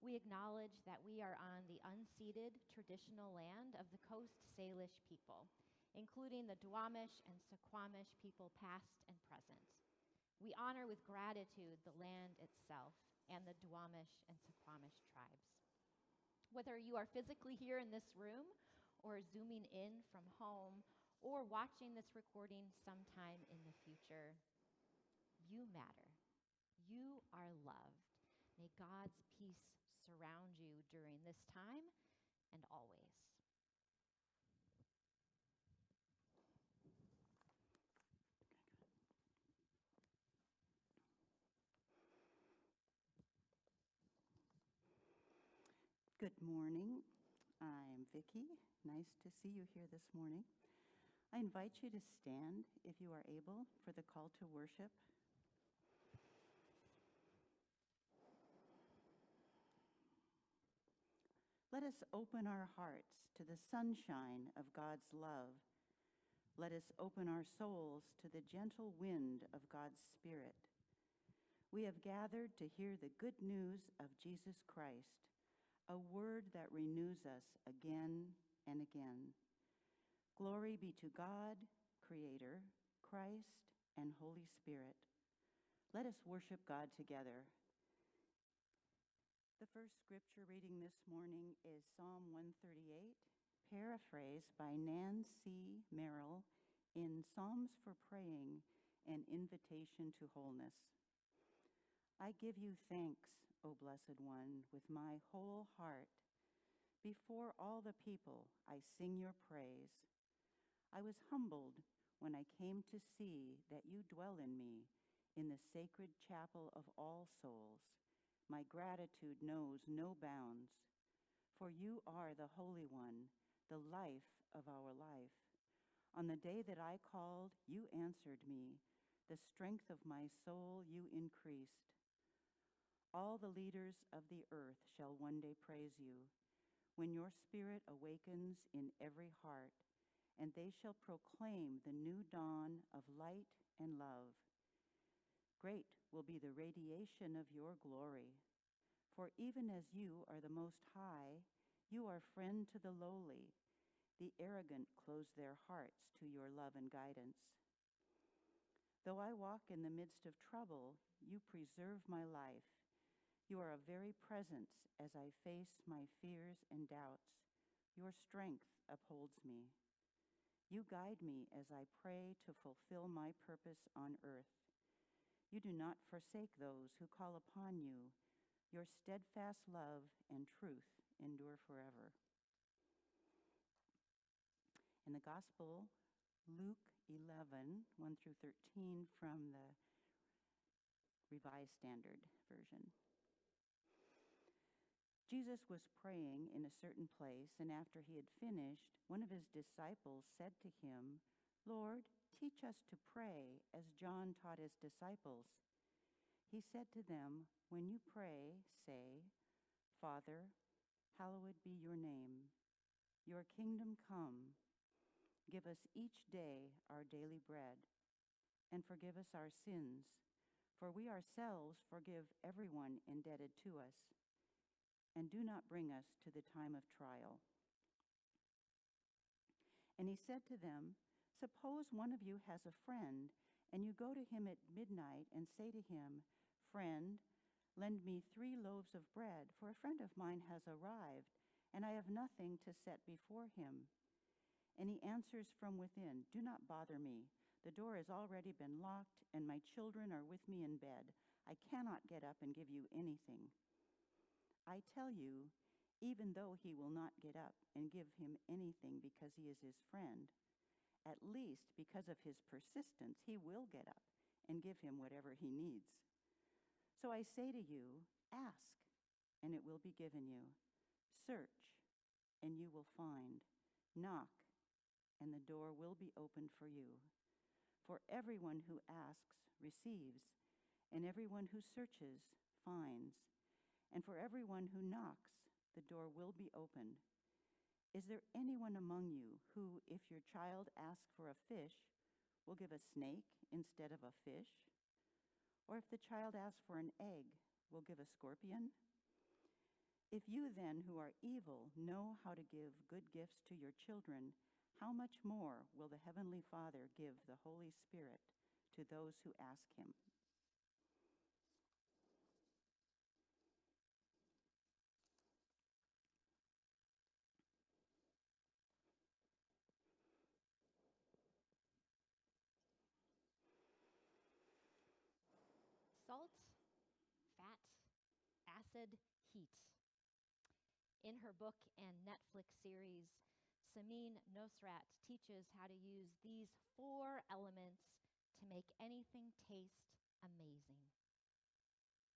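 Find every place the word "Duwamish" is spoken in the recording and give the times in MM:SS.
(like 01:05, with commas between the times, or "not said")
00:06, 00:13.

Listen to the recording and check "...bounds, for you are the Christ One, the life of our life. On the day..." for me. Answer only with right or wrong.
wrong.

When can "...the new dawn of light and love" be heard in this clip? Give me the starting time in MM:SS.
02:21.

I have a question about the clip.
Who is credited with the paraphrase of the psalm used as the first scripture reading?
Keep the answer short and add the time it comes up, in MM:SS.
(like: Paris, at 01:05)
Nan C. Merrill, at 01:34.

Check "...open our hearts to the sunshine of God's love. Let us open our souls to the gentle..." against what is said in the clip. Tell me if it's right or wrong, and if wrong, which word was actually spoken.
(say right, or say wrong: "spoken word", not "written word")
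right.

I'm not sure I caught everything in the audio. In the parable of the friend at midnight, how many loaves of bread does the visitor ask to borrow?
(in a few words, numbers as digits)
3.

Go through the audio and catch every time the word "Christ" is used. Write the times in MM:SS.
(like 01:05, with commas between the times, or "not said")
01:14, 01:23.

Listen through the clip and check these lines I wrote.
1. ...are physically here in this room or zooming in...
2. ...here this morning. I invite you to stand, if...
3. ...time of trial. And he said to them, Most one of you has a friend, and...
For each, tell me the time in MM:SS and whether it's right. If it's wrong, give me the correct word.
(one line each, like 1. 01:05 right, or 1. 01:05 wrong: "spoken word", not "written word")
1. 00:16 right
2. 00:49 right
3. 03:46 wrong: "Suppose", not "Most".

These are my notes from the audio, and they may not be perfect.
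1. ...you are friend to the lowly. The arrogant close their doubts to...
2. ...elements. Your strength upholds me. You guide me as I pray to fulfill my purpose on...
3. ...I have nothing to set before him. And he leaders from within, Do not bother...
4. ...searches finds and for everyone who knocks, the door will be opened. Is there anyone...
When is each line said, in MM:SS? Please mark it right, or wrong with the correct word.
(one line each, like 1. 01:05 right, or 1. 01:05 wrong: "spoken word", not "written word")
1. 02:31 wrong: "hearts", not "doubts"
2. 02:46 wrong: "doubts", not "elements"
3. 04:01 wrong: "answers", not "leaders"
4. 04:41 right.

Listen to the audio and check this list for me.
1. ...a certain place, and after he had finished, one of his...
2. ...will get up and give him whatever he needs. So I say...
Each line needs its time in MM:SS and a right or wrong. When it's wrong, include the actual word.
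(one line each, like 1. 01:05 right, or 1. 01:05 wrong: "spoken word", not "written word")
1. 03:16 right
2. 04:23 right.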